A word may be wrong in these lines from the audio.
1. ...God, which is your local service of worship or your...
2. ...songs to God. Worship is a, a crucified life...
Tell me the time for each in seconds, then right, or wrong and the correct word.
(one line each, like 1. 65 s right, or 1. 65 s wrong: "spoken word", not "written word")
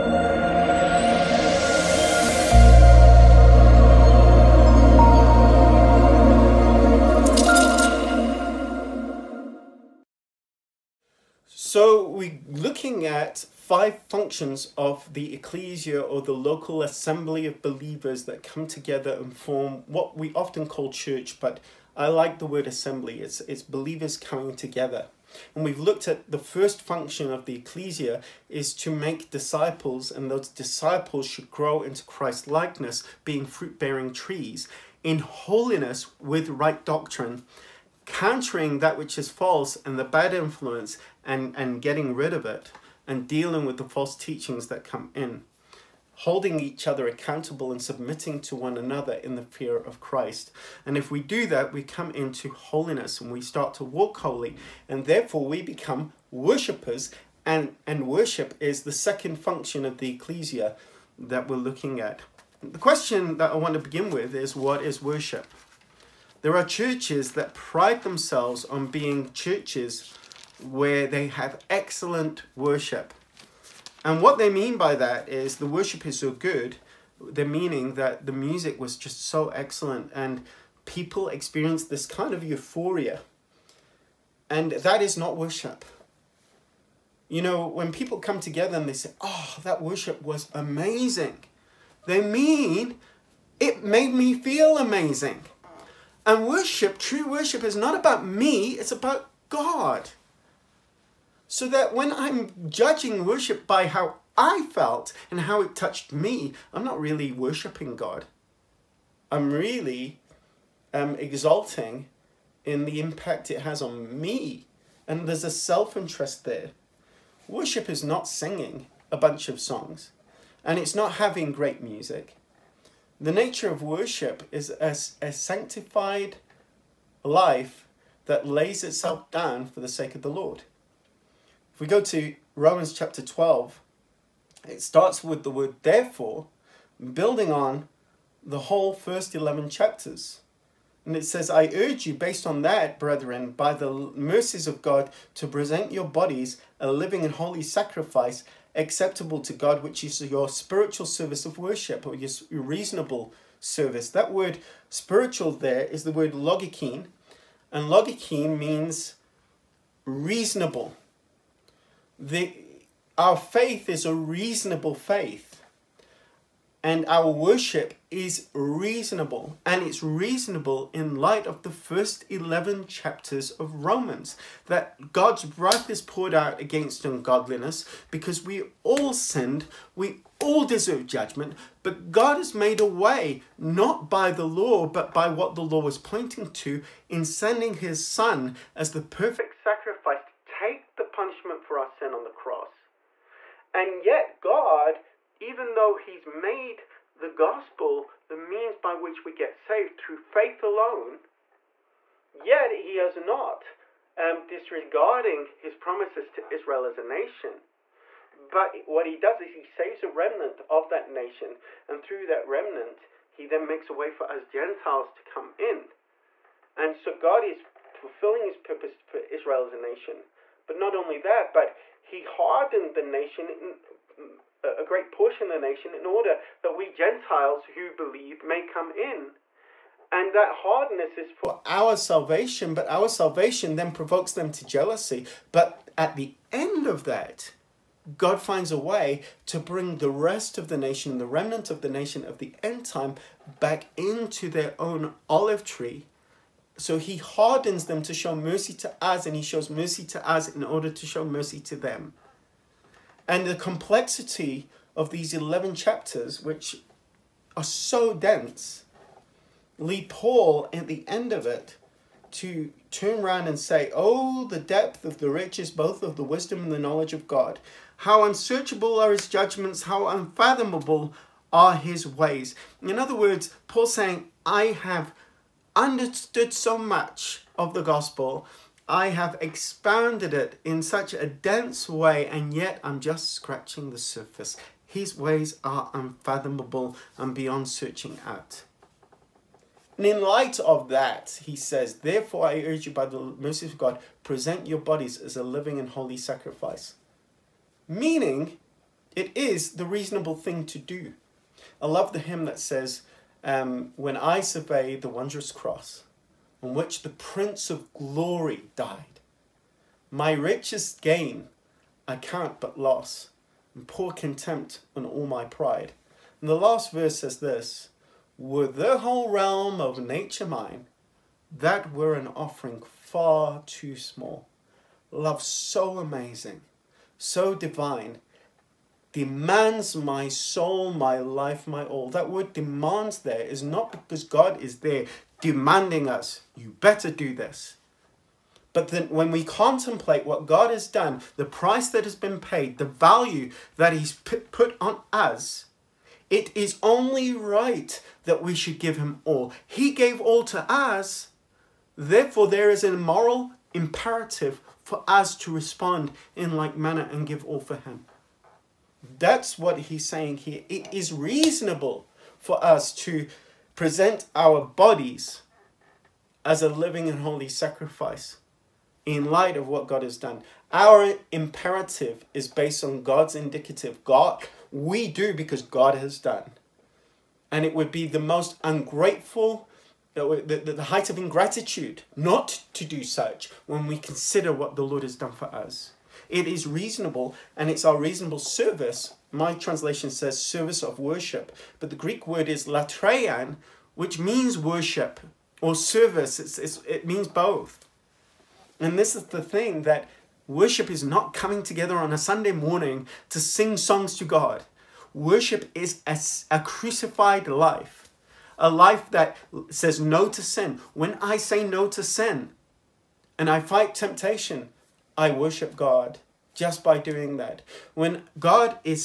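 1. 149 s wrong: "spiritual", not "local"
2. 403 s right.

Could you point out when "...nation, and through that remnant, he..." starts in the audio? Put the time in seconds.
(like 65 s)
211 s.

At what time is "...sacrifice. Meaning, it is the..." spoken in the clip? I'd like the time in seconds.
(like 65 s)
296 s.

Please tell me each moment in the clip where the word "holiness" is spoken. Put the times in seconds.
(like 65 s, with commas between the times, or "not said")
35 s, 52 s.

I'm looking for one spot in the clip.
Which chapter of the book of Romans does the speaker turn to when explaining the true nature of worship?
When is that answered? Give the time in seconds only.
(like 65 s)
132 s.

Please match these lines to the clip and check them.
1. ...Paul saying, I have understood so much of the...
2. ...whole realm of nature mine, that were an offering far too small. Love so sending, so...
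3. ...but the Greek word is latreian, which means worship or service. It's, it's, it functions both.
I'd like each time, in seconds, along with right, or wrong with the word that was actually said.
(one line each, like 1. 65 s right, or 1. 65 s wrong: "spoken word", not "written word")
1. 273 s right
2. 318 s wrong: "amazing", not "sending"
3. 391 s wrong: "means", not "functions".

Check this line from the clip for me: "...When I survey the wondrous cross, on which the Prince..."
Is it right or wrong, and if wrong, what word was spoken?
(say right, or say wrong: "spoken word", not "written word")
right.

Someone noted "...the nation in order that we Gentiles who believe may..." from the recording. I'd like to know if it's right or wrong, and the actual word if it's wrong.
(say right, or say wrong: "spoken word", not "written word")
right.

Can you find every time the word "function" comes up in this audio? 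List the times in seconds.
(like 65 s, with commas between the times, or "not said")
14 s, 26 s, 59 s.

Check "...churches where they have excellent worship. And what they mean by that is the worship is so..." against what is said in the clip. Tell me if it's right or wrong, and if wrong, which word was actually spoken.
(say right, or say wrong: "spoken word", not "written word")
right.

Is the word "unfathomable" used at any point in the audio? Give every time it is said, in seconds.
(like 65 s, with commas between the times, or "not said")
270 s, 285 s.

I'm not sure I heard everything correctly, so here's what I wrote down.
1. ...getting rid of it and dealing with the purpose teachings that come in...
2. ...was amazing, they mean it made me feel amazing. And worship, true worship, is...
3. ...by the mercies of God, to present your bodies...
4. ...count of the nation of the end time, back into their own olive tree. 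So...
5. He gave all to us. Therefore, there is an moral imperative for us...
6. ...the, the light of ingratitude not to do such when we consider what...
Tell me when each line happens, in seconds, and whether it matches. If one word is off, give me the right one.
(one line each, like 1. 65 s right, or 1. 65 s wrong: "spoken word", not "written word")
1. 41 s wrong: "false", not "purpose"
2. 90 s right
3. 143 s right
4. 241 s wrong: "remnant", not "count"
5. 349 s right
6. 380 s wrong: "height", not "light".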